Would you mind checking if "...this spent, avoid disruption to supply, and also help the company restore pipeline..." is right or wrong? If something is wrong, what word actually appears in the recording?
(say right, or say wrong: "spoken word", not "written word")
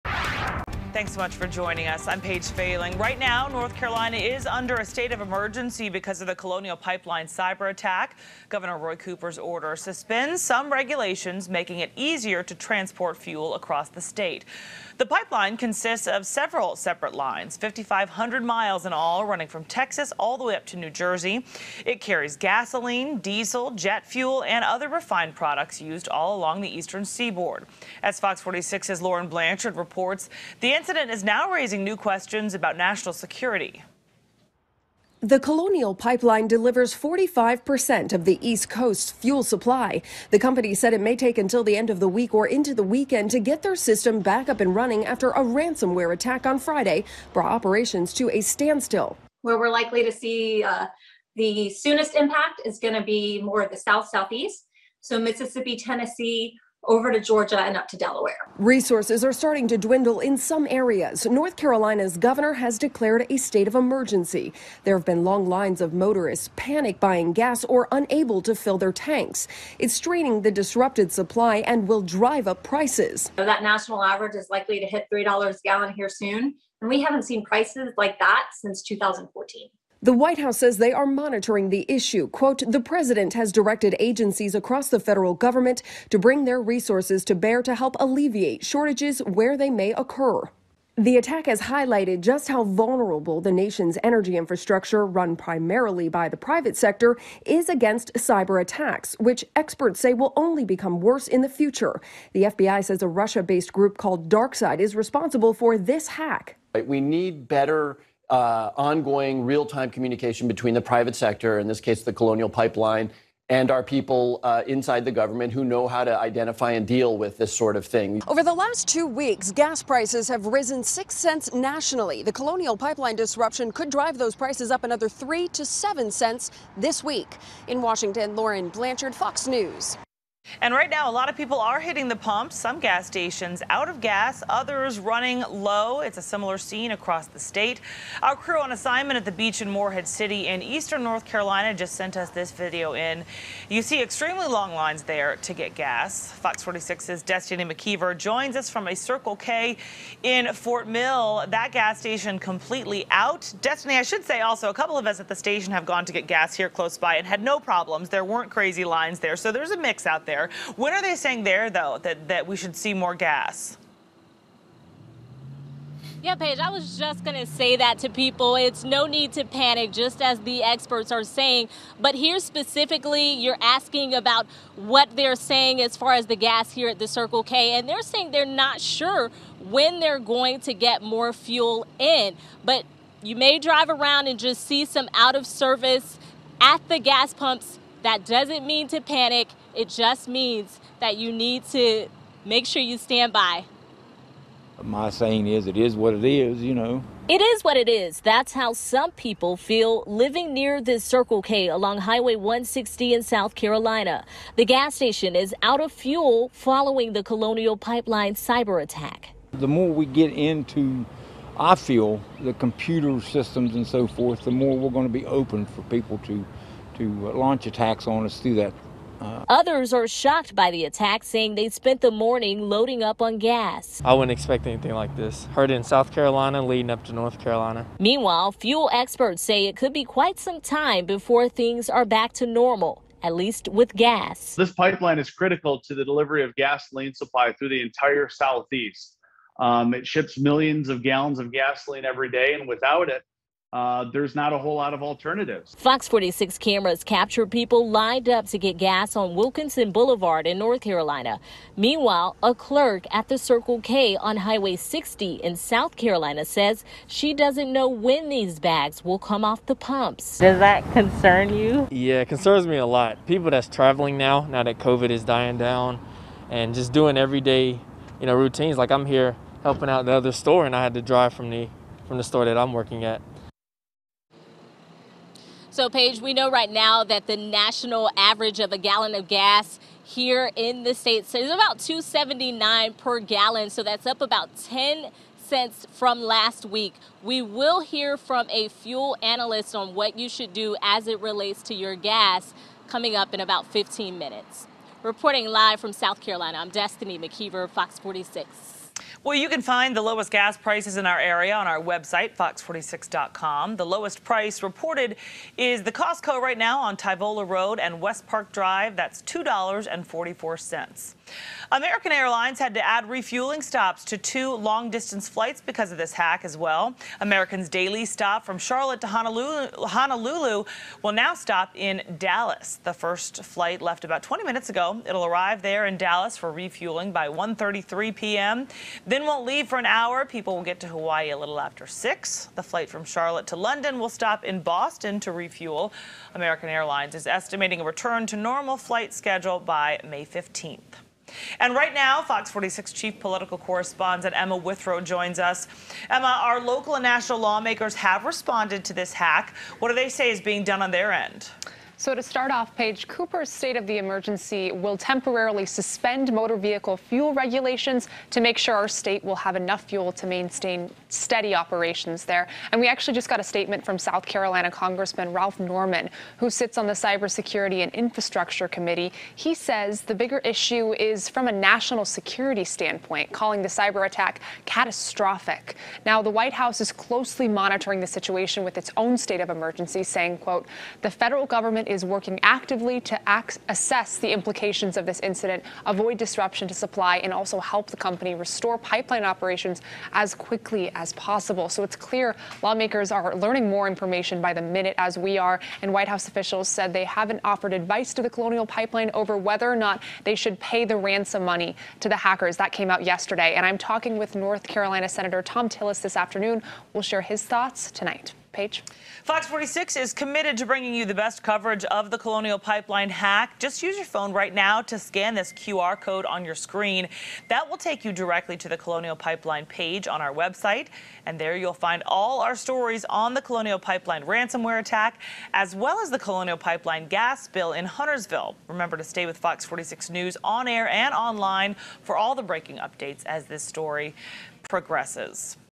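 wrong: "incident", not "spent".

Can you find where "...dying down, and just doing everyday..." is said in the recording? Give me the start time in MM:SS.
04:25.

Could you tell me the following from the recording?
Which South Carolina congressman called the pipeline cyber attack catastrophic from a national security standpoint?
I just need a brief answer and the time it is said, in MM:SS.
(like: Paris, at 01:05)
Ralph Norman, at 06:05.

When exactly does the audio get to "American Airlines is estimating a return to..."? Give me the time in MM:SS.
05:36.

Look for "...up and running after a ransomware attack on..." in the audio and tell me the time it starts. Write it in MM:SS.
00:44.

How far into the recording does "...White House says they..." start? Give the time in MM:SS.
01:20.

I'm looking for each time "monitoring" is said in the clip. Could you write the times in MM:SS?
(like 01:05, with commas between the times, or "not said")
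01:21, 06:17.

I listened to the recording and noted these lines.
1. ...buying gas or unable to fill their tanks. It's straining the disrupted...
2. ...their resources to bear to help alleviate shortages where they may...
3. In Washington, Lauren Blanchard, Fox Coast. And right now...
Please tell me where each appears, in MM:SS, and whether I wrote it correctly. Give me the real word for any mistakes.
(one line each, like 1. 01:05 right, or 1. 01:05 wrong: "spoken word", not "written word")
1. 01:06 right
2. 01:26 right
3. 02:07 wrong: "News", not "Coast".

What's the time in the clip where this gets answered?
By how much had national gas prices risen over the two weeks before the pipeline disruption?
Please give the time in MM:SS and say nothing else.
02:00.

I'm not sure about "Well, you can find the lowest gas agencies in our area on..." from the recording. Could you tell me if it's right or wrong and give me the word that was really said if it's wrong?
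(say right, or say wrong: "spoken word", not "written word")
wrong: "prices", not "agencies".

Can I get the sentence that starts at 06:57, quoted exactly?
That will take you directly to the Colonial Pipeline page on our website.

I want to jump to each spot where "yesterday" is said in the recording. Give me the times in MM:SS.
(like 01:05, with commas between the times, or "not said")
06:43.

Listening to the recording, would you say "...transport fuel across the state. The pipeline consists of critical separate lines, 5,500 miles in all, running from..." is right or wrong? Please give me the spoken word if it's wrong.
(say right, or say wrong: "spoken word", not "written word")
wrong: "several", not "critical".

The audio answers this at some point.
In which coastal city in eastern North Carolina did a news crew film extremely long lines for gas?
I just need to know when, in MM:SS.
02:19.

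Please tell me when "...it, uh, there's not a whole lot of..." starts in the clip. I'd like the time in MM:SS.
04:03.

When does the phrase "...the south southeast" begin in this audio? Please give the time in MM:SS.
00:53.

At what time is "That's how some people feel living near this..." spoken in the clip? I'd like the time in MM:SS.
03:18.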